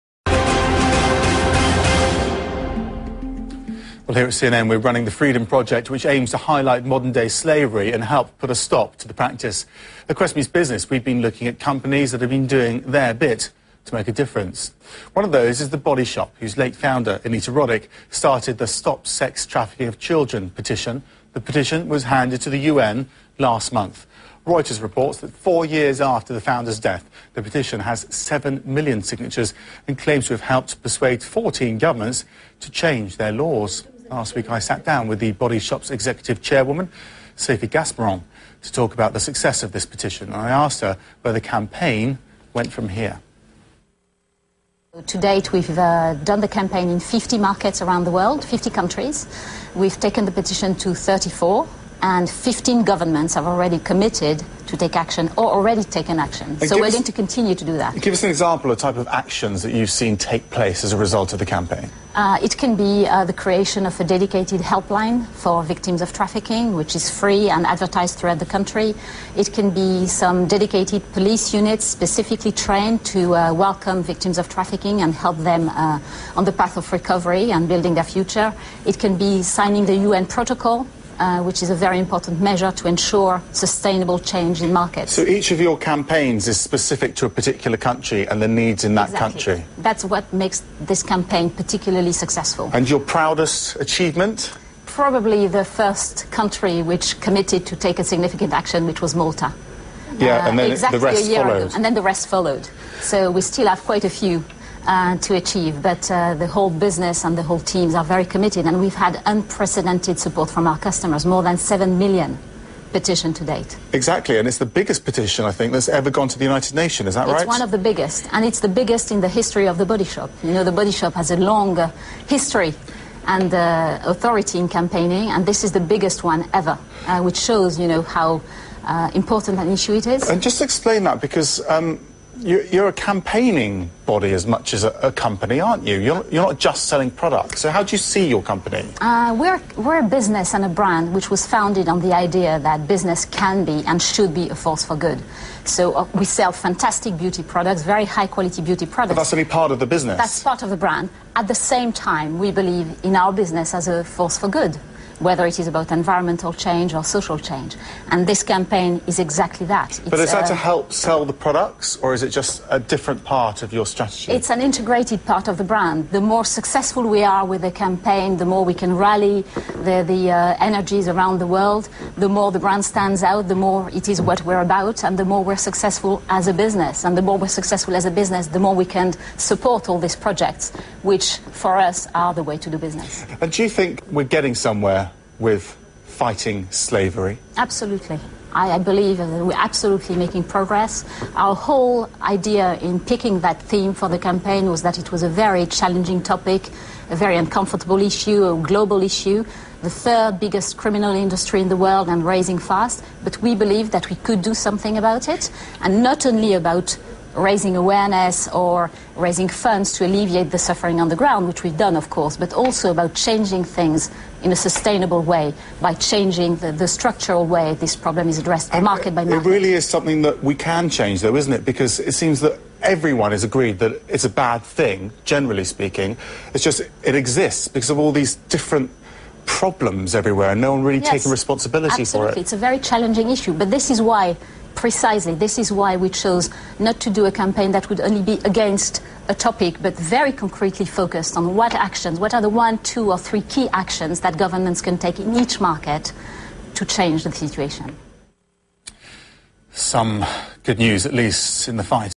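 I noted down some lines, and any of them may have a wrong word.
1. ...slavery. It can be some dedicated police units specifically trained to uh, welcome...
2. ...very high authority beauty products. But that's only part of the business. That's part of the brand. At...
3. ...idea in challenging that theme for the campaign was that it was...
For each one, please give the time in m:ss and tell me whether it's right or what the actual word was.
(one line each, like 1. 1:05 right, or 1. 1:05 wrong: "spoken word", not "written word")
1. 1:08 wrong: "country", not "slavery"
2. 2:27 wrong: "quality", not "authority"
3. 3:12 wrong: "picking", not "challenging".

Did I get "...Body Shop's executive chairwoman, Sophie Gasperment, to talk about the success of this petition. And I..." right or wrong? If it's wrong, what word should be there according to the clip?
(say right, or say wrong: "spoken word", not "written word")
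right.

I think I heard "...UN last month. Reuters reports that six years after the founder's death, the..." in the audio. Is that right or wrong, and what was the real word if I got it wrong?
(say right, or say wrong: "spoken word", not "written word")
wrong: "four", not "six".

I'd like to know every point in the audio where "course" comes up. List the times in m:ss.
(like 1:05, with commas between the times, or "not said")
3:32.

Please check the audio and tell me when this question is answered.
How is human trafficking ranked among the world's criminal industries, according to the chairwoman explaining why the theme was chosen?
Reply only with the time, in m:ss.
3:19.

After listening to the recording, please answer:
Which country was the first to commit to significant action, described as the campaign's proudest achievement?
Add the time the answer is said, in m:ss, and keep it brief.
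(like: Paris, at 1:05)
Malta, at 1:39.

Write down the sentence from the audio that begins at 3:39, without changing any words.
It really is something that we can change, though, isn't it?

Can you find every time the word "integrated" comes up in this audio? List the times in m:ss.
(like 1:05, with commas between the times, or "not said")
2:44.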